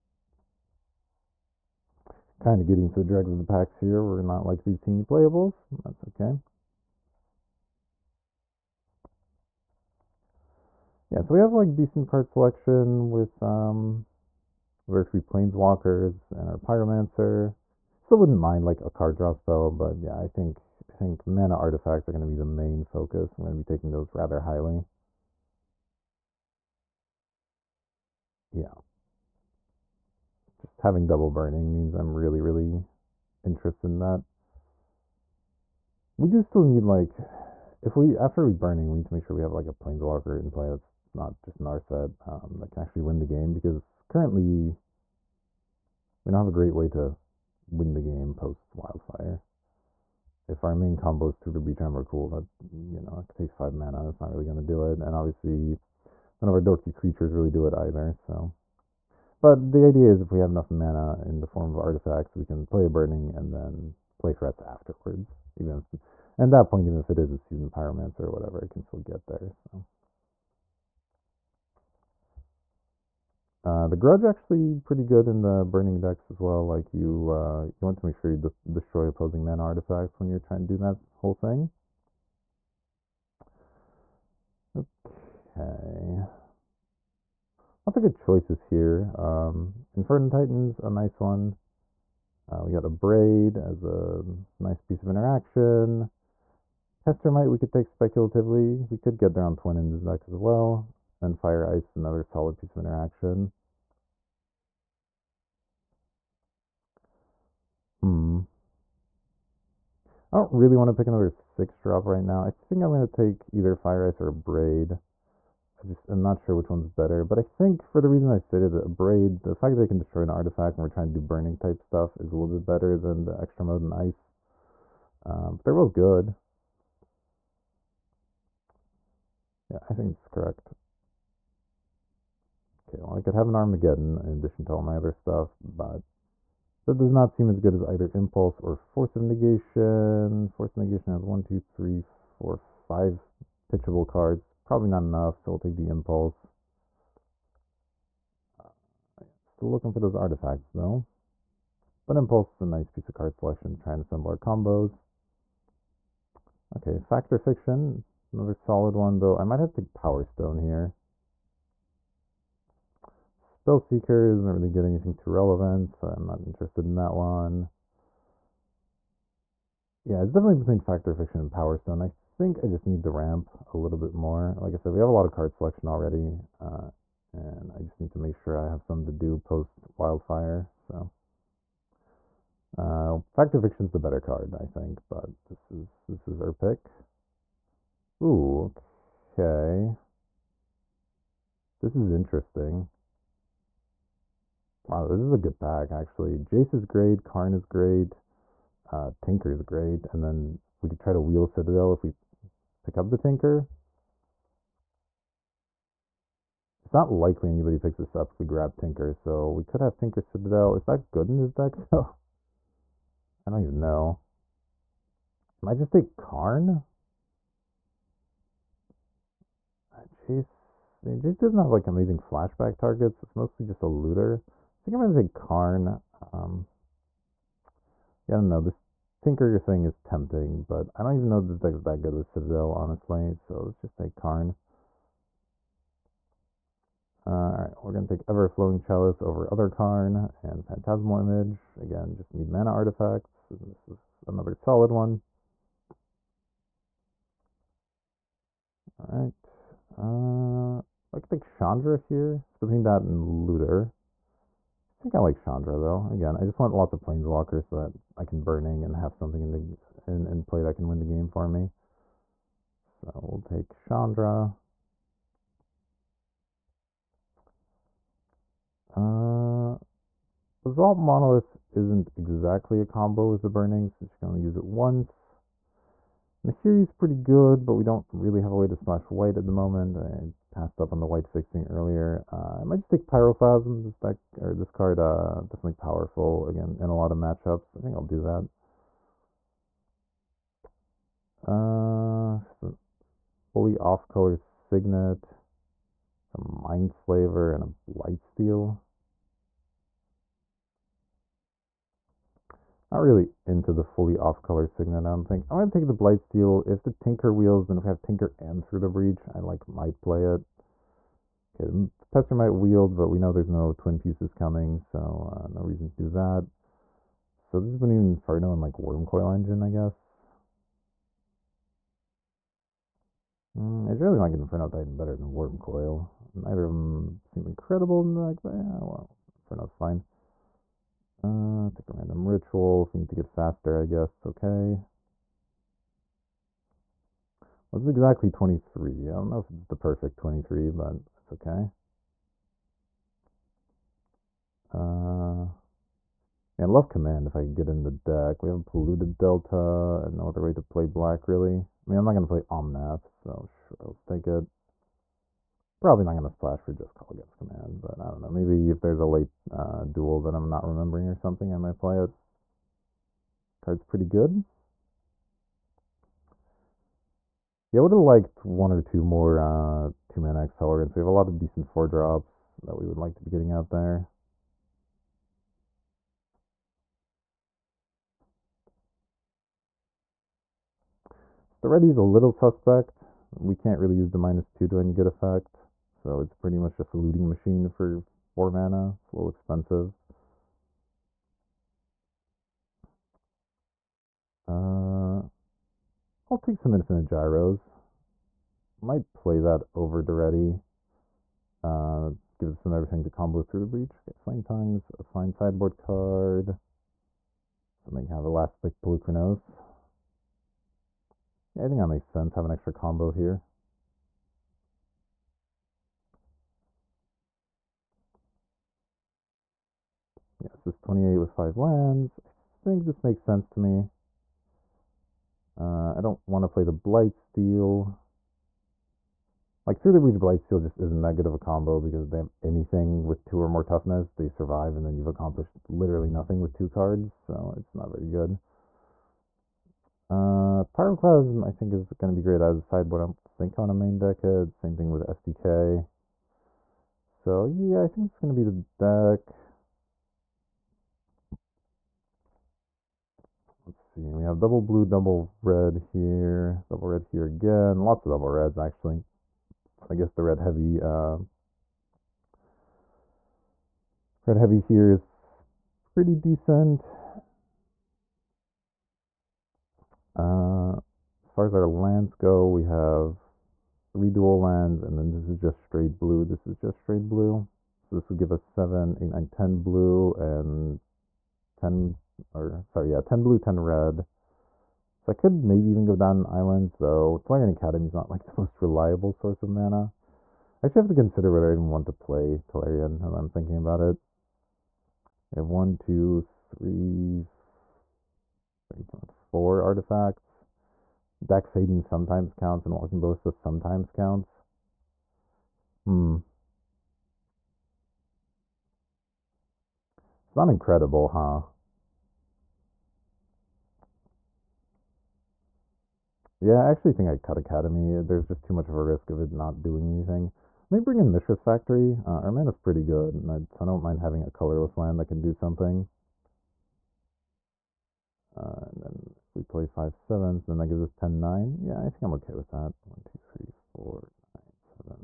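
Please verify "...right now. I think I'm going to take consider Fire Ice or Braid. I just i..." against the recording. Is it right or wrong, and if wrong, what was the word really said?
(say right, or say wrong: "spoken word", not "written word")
wrong: "either", not "consider".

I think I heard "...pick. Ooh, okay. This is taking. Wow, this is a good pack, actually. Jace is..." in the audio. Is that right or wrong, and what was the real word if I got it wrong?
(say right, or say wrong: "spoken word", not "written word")
wrong: "interesting", not "taking".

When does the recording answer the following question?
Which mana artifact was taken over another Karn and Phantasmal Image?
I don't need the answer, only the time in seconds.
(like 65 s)
238 s.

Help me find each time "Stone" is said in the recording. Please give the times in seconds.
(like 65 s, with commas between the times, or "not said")
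160 s, 171 s.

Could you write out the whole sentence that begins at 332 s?
If we need to get faster, I guess it's okay.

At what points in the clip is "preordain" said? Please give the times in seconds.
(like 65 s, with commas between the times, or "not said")
not said.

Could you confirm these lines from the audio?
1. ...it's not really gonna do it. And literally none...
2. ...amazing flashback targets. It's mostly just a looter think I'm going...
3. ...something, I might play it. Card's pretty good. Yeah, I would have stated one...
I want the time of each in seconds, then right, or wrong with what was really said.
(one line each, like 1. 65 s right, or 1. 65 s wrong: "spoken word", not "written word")
1. 54 s wrong: "obviously", not "literally"
2. 221 s right
3. 361 s wrong: "liked", not "stated".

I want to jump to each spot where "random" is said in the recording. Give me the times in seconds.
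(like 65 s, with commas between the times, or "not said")
331 s.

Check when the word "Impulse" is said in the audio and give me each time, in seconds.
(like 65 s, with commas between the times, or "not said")
138 s, 145 s, 152 s.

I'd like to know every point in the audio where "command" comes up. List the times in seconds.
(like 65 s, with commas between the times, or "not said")
346 s, 357 s.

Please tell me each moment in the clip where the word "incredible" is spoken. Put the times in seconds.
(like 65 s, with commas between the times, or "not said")
327 s, 510 s.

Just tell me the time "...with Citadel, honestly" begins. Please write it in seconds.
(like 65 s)
232 s.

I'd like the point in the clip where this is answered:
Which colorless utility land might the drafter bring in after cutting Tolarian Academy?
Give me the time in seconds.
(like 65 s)
521 s.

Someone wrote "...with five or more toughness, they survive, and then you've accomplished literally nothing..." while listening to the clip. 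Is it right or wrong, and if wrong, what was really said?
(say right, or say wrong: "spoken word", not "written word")
wrong: "two", not "five".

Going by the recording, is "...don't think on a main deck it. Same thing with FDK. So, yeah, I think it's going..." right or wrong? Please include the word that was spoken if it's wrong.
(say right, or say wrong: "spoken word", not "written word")
right.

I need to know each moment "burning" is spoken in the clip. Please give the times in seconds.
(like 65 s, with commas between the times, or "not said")
31 s, 38 s, 62 s, 75 s, 121 s, 258 s, 273 s.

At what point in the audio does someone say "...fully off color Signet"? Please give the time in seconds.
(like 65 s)
293 s.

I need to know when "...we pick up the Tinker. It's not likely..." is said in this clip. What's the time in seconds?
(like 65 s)
202 s.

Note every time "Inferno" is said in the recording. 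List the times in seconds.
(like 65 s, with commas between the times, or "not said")
89 s, 318 s, 324 s, 329 s.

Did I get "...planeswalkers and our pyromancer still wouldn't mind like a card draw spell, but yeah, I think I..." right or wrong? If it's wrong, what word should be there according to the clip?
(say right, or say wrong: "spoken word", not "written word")
right.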